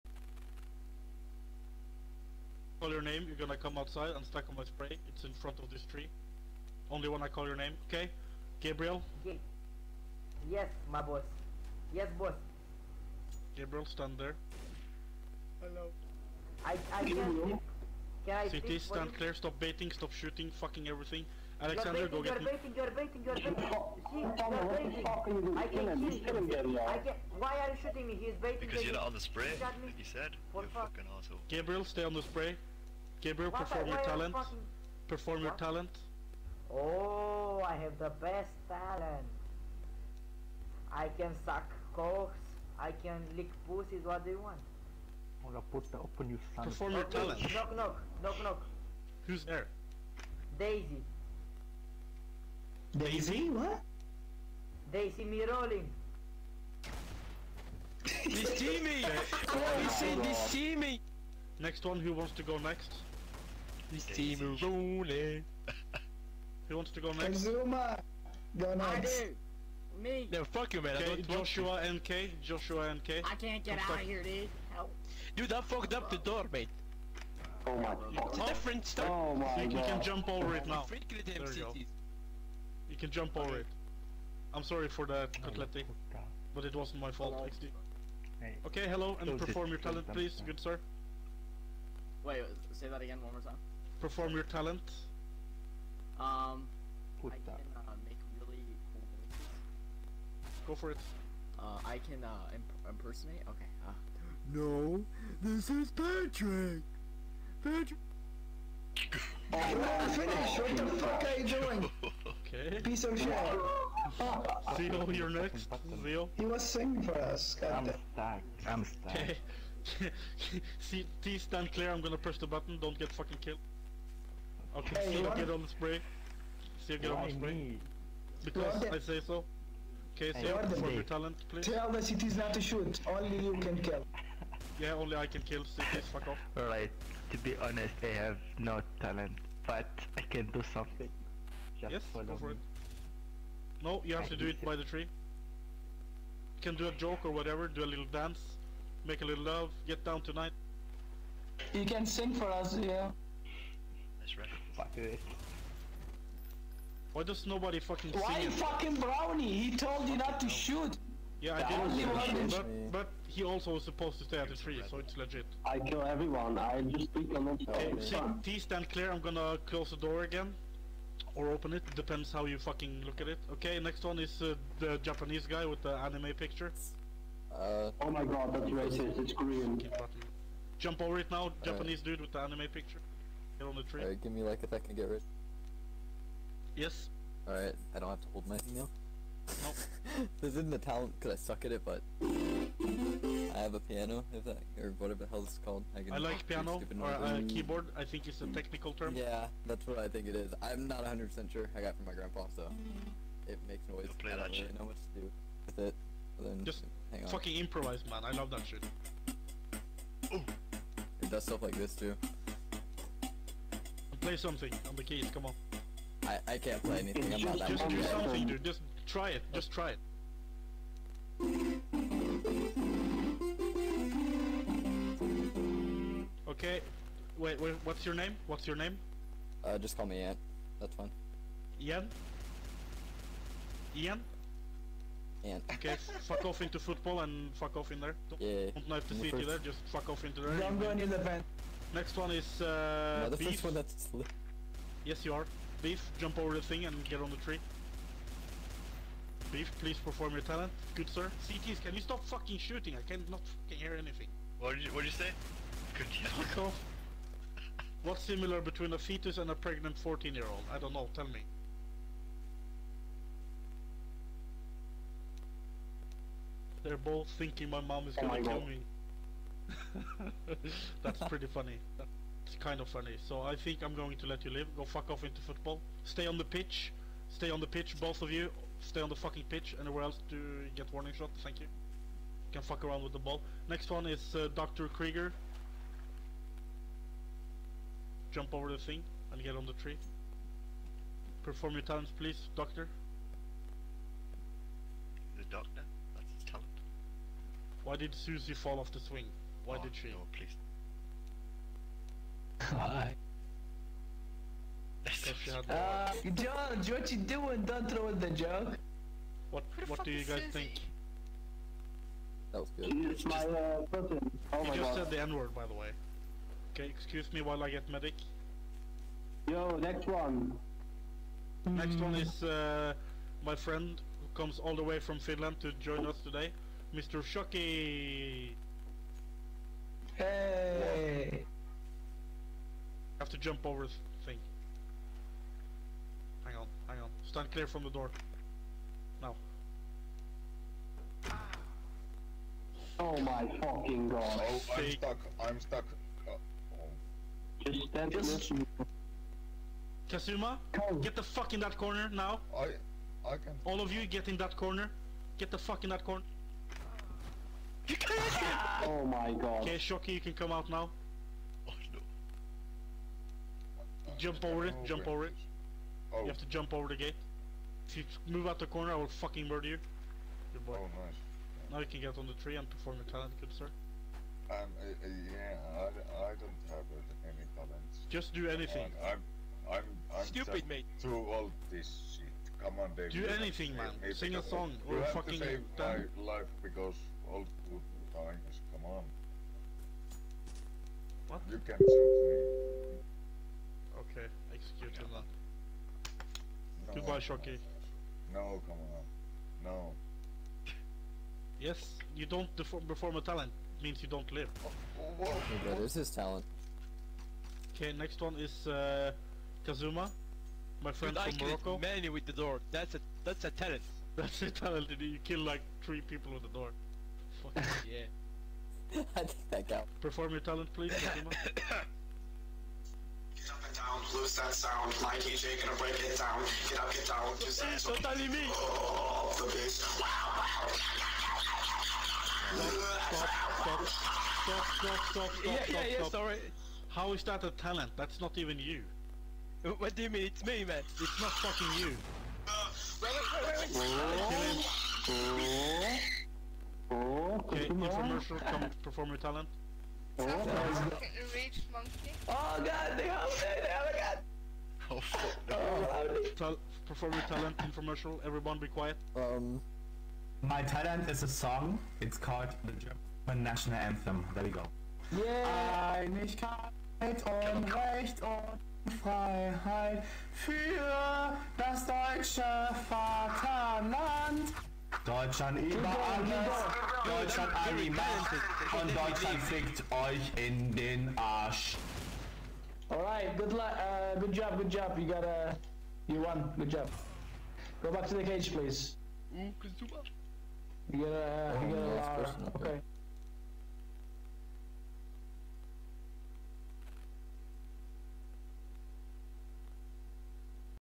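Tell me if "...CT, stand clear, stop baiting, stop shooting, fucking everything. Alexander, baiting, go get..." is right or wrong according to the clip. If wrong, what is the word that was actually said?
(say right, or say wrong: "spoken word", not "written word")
right.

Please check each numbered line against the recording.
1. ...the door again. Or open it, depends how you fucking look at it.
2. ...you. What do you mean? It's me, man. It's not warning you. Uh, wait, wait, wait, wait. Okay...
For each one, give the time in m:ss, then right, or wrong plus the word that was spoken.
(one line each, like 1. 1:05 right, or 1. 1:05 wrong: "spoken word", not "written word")
1. 2:49 right
2. 7:18 wrong: "fucking", not "warning".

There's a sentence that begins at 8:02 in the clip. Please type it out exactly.
Alright, good luck, uh, good job, good job.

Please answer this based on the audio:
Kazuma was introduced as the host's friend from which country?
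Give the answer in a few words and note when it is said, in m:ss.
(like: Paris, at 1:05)
Morocco, at 6:51.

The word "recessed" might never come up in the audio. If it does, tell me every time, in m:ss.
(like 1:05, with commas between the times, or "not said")
not said.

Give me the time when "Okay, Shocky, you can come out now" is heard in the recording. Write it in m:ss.
5:59.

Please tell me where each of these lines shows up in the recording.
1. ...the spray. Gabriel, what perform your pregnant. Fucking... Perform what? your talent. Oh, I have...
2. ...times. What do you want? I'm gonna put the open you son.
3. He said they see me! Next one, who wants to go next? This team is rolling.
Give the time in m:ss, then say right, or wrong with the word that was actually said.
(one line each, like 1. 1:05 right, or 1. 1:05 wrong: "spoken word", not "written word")
1. 0:32 wrong: "talent", not "pregnant"
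2. 0:43 wrong: "pussies", not "times"
3. 0:59 right.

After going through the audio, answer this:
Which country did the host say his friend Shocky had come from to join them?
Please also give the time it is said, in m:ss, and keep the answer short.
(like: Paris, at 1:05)
Finland, at 5:25.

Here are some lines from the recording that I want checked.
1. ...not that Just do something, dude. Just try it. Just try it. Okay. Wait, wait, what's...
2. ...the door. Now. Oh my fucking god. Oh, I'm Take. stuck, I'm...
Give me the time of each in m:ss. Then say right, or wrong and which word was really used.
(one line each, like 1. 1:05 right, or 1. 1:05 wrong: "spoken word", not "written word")
1. 3:37 right
2. 5:37 right.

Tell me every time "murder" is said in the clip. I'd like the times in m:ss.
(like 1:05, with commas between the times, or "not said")
6:09.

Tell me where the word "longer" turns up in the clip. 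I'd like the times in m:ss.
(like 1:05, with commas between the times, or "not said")
not said.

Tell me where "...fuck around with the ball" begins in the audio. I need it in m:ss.
4:42.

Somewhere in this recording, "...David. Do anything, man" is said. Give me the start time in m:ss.
6:22.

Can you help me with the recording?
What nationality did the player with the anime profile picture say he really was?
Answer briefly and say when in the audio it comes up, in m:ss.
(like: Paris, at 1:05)
Korean, at 2:59.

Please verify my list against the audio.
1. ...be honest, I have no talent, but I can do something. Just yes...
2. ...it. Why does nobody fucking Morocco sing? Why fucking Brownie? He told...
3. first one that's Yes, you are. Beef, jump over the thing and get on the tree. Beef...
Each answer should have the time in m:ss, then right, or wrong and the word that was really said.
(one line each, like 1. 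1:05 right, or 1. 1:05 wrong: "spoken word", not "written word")
1. 2:17 right
2. 2:34 wrong: "Why", not "Morocco"
3. 4:03 right.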